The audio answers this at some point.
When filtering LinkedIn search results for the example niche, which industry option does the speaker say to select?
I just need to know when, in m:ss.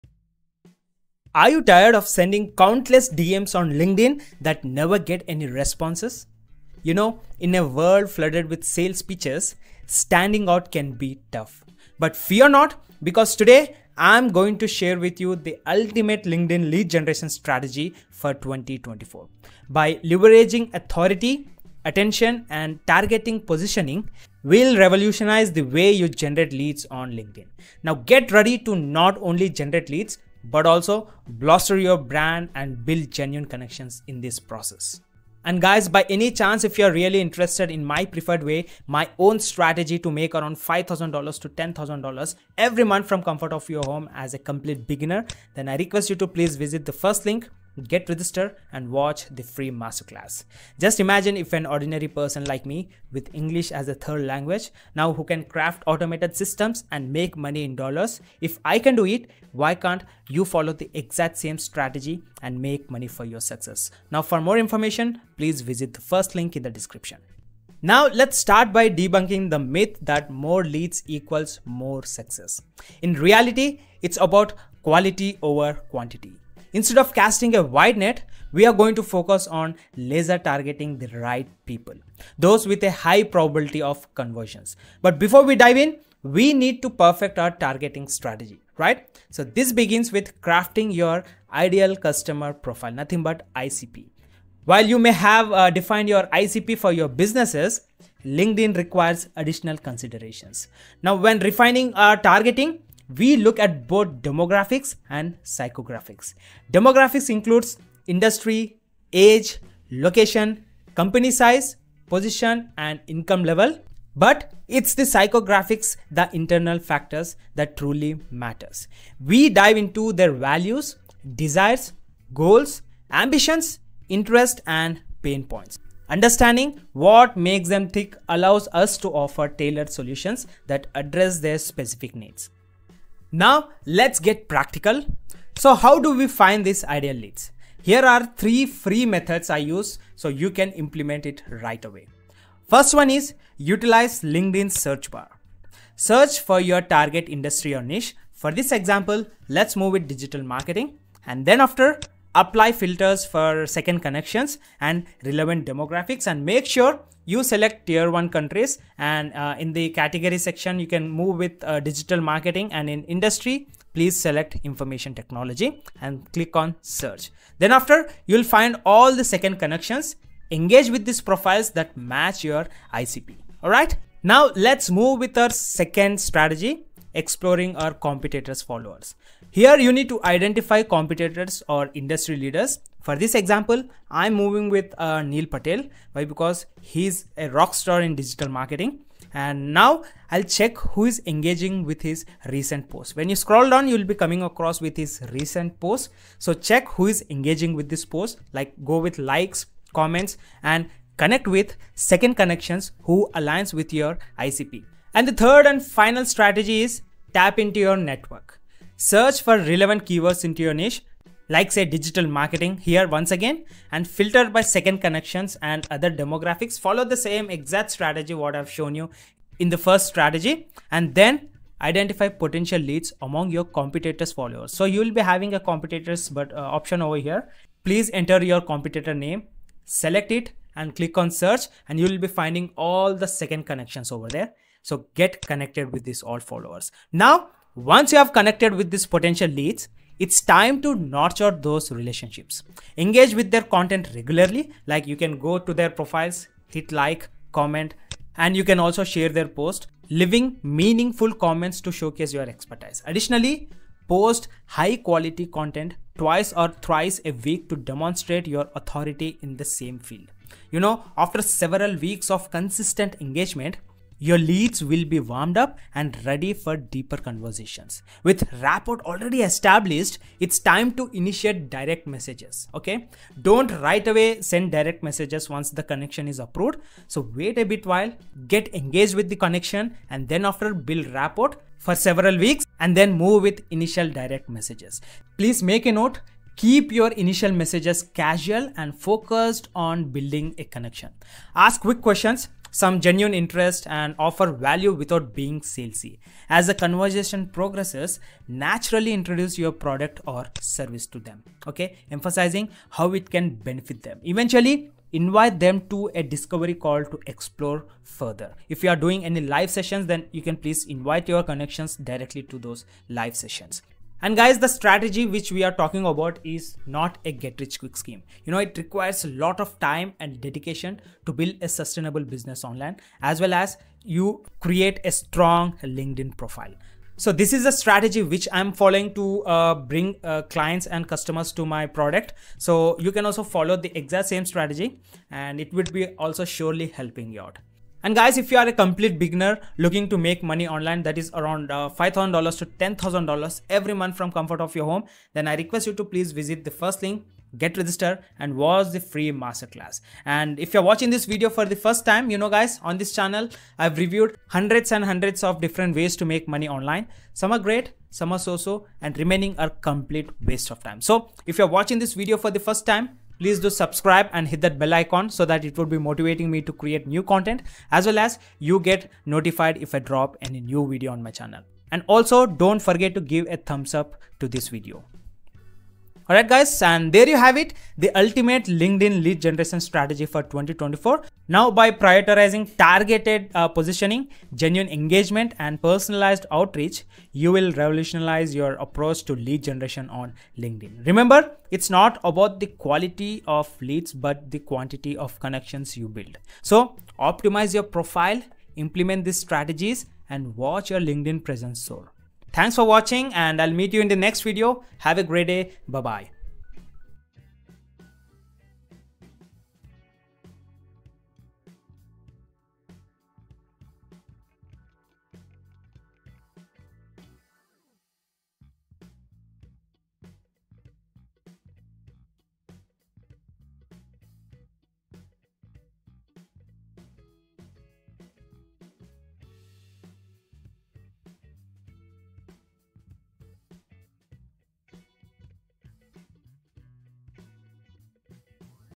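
2:44.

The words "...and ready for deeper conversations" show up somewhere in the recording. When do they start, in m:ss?
4:25.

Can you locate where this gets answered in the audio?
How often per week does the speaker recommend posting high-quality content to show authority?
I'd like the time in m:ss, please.
4:16.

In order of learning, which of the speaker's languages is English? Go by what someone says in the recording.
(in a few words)
third language.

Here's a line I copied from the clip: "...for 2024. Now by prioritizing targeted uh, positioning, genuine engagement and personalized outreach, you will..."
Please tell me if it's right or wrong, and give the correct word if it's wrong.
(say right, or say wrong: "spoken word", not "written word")
right.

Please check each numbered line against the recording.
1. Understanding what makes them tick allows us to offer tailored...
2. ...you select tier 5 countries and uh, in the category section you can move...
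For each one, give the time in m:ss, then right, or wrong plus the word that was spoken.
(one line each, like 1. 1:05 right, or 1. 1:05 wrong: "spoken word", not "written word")
1. 2:06 right
2. 2:37 wrong: "1", not "5".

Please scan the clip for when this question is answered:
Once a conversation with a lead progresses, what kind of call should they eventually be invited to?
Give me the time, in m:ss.
5:06.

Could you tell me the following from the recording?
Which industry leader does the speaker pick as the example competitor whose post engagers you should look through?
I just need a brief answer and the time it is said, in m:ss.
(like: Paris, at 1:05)
Neil Patel, at 3:05.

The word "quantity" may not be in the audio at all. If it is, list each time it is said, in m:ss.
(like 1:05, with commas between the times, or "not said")
1:15, 6:34.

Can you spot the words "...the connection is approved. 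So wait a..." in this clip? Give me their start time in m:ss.
4:35.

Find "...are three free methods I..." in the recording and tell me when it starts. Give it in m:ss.
2:18.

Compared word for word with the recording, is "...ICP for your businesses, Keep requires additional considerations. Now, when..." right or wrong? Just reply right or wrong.
wrong.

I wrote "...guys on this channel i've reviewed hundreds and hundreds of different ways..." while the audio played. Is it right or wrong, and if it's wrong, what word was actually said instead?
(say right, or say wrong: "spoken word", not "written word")
right.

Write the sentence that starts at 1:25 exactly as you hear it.
But before we dive in, we need to perfect our targeting strategy, right?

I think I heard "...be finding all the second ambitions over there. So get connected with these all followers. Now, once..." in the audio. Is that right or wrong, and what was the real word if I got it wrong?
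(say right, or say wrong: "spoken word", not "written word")
wrong: "connections", not "ambitions".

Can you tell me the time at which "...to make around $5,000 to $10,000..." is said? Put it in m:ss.
0:39.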